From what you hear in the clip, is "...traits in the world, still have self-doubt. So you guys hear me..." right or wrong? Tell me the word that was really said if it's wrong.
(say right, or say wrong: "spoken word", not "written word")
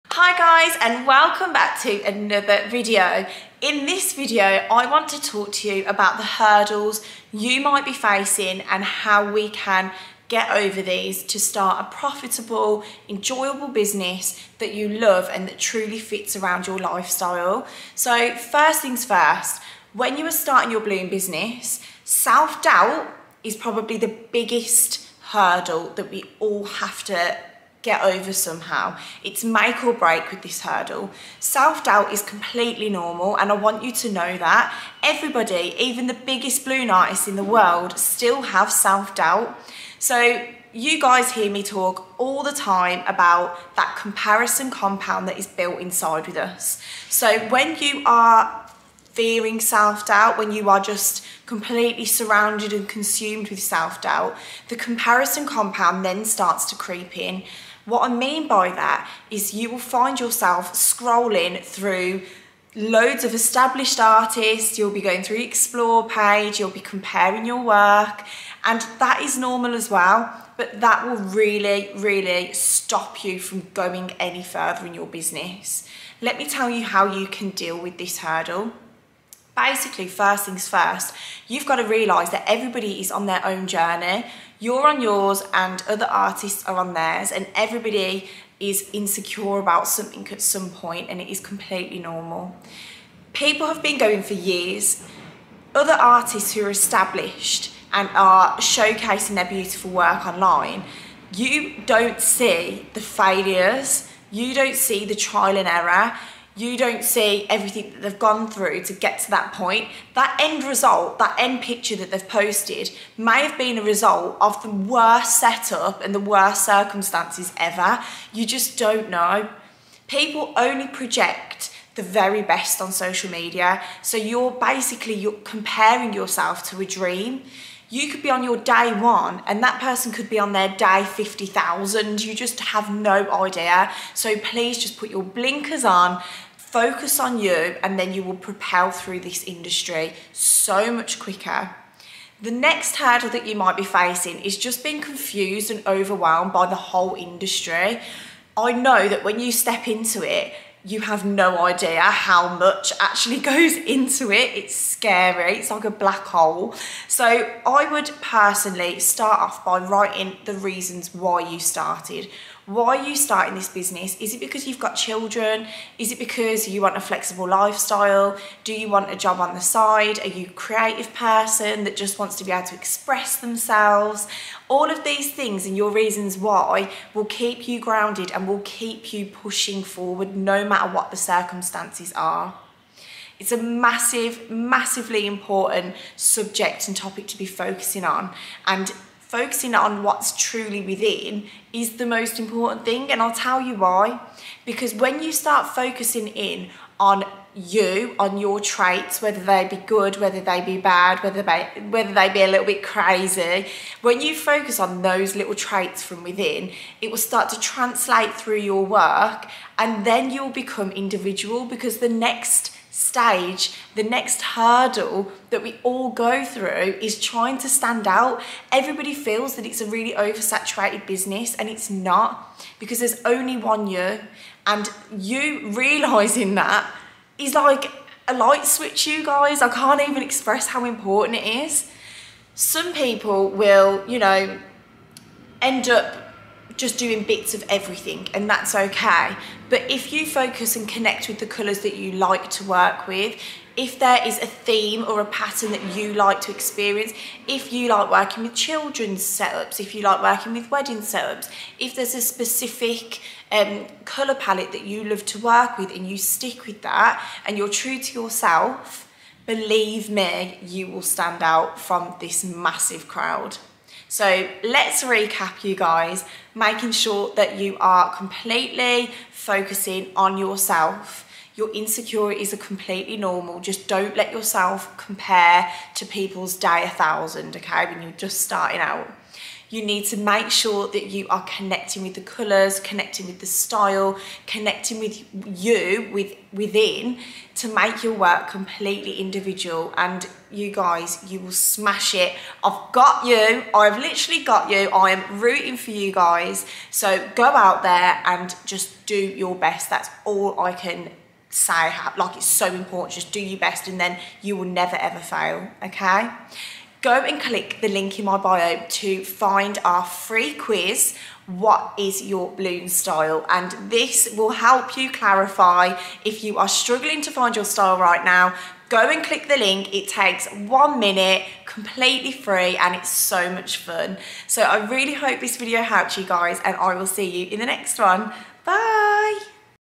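wrong: "artists", not "traits".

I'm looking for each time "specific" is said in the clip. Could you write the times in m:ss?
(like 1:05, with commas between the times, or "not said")
4:12.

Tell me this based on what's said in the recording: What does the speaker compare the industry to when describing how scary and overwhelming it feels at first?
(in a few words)
a black hole.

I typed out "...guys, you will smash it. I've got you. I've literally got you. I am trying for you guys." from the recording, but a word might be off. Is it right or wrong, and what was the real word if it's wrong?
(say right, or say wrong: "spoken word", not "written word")
wrong: "rooting", not "trying".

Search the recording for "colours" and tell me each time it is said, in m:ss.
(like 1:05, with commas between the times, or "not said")
4:01, 4:14, 4:42.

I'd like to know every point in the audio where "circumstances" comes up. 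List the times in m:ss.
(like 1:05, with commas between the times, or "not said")
1:56, 3:01.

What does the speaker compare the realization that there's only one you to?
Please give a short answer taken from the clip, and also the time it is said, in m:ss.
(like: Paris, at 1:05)
light switch, at 3:48.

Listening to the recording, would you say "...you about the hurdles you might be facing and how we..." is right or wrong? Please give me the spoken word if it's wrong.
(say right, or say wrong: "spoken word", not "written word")
right.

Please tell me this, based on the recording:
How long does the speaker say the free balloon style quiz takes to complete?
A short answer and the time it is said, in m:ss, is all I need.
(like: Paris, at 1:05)
one minute, at 5:20.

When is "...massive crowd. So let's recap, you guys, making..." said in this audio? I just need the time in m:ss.
4:22.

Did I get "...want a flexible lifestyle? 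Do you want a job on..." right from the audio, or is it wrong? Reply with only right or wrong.
right.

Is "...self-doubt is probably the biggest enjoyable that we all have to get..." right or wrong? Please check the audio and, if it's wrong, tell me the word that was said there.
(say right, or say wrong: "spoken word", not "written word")
wrong: "hurdle", not "enjoyable".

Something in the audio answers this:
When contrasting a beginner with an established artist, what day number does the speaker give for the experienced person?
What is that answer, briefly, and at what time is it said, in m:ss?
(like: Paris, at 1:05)
50,000, at 2:10.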